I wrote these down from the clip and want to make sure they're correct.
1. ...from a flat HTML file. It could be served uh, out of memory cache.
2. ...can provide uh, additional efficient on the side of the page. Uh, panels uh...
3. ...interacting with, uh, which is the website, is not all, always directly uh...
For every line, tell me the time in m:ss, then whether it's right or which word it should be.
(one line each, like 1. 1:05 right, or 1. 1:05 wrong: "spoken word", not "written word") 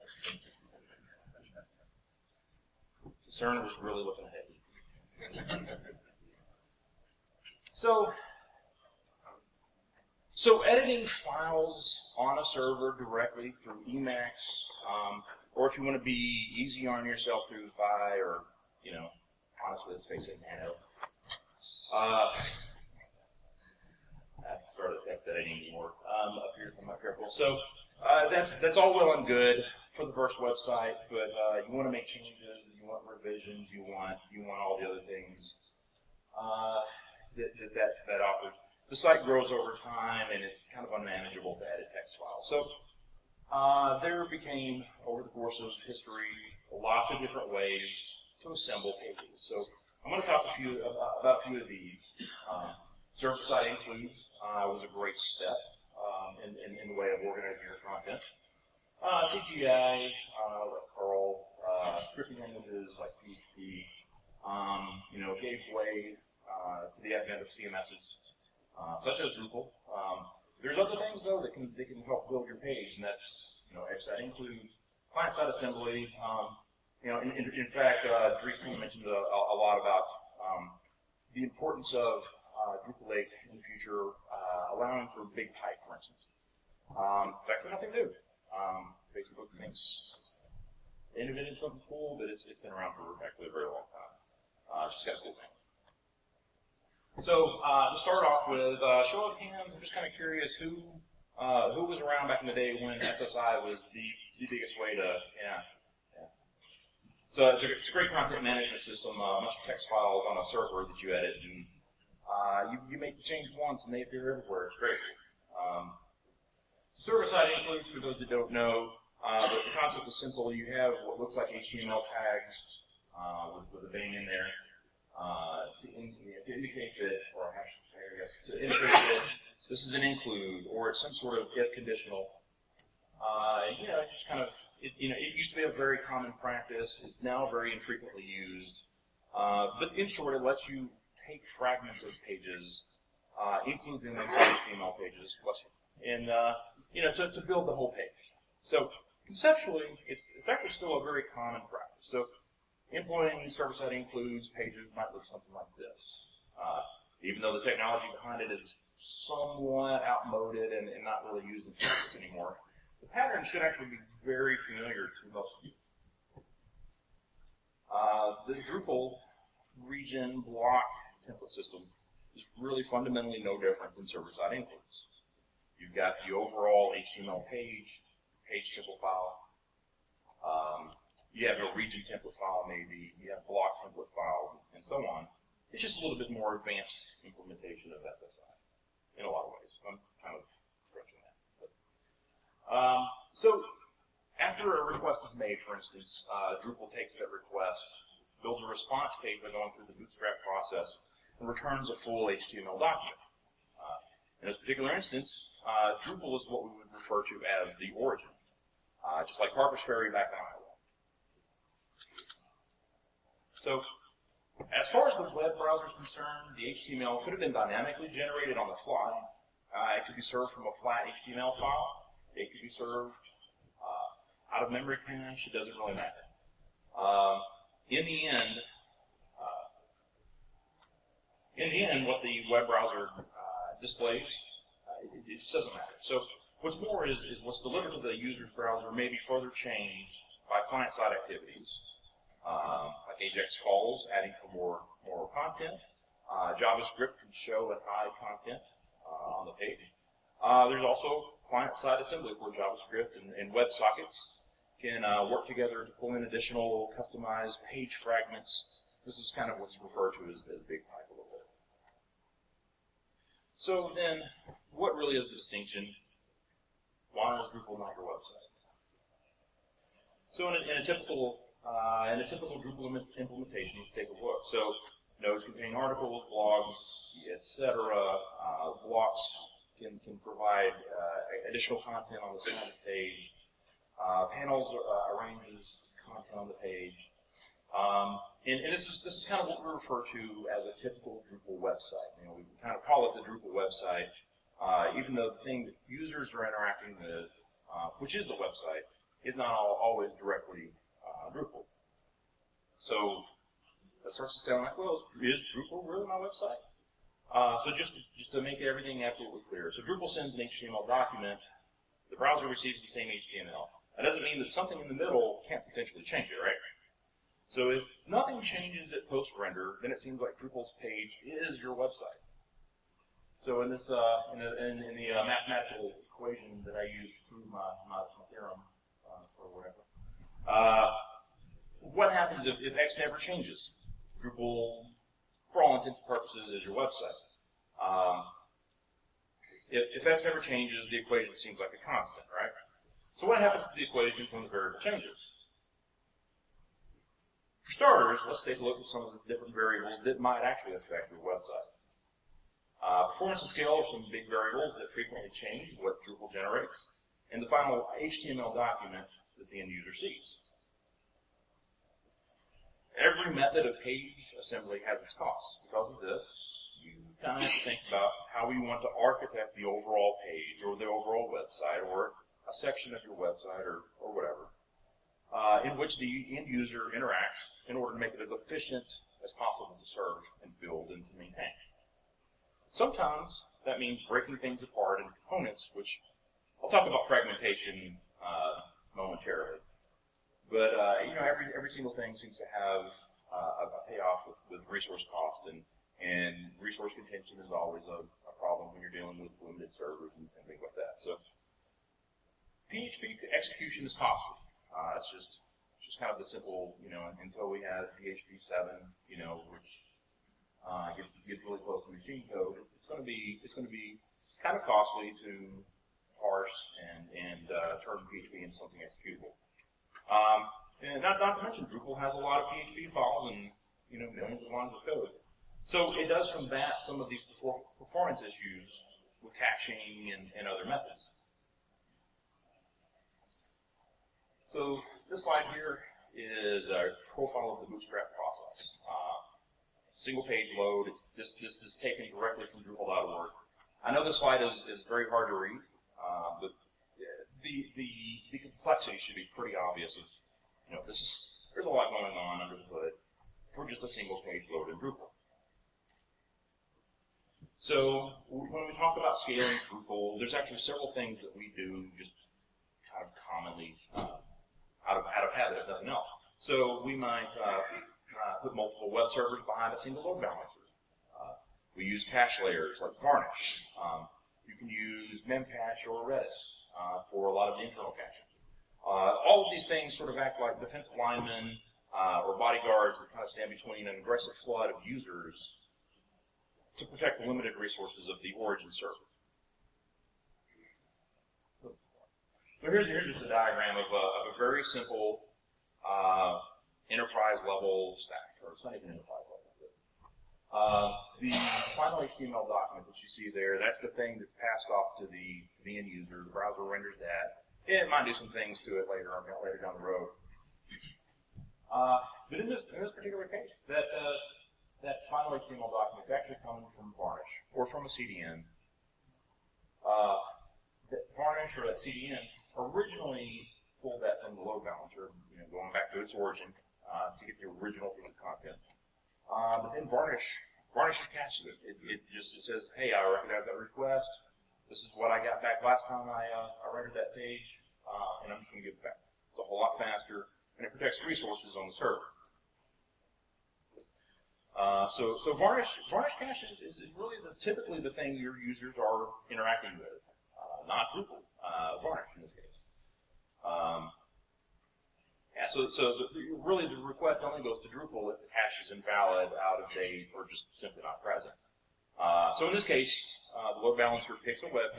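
1. 3:40 right
2. 4:40 wrong: "content", not "efficient"
3. 4:56 right.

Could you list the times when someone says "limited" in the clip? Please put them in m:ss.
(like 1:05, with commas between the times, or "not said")
6:39, 8:07.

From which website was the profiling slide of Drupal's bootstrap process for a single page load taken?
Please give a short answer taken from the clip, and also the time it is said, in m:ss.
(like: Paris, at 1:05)
Drupal.org, at 7:22.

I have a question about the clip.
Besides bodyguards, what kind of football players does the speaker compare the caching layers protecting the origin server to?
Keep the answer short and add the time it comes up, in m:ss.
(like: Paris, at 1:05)
Defensive linemen, at 8:00.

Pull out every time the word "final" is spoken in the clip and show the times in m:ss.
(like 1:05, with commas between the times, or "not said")
5:57, 8:21, 8:35.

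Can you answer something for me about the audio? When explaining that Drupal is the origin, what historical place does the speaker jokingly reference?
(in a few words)
Harper's Ferry.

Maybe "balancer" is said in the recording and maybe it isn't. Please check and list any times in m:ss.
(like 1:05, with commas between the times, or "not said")
7:50, 8:44, 9:23.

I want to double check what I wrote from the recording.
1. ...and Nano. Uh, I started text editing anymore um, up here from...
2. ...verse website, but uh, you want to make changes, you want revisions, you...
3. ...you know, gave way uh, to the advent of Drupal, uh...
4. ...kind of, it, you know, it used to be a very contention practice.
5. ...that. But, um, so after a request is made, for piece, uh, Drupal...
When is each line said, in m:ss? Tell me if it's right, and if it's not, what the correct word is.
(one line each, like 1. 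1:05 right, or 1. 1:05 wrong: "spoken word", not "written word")
1. 0:20 right
2. 0:30 right
3. 1:05 wrong: "CMSs", not "Drupal"
4. 2:14 wrong: "common", not "contention"
5. 3:11 wrong: "instance", not "piece".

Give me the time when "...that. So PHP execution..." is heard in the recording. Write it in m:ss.
6:40.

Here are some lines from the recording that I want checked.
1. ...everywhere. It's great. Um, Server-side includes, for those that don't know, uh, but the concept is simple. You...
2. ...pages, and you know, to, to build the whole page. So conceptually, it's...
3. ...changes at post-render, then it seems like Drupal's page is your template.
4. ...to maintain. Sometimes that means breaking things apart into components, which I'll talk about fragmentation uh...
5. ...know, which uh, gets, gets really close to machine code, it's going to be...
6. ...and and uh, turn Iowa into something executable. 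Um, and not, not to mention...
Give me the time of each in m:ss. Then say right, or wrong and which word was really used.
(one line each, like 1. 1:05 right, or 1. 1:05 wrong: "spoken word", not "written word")
1. 1:54 right
2. 2:24 right
3. 5:18 wrong: "website", not "template"
4. 6:21 right
5. 6:49 right
6. 6:56 wrong: "PHP", not "Iowa".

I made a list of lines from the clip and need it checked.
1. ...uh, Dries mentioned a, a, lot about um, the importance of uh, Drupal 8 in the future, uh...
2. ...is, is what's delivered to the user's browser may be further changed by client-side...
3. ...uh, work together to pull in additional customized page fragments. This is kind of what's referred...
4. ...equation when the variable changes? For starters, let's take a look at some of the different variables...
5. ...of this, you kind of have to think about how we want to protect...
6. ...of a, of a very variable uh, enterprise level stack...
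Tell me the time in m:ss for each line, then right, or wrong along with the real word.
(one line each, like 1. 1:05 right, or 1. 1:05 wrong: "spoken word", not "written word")
1. 1:18 right
2. 3:57 right
3. 4:15 right
4. 5:43 right
5. 6:05 wrong: "architect", not "protect"
6. 8:13 wrong: "simple", not "variable".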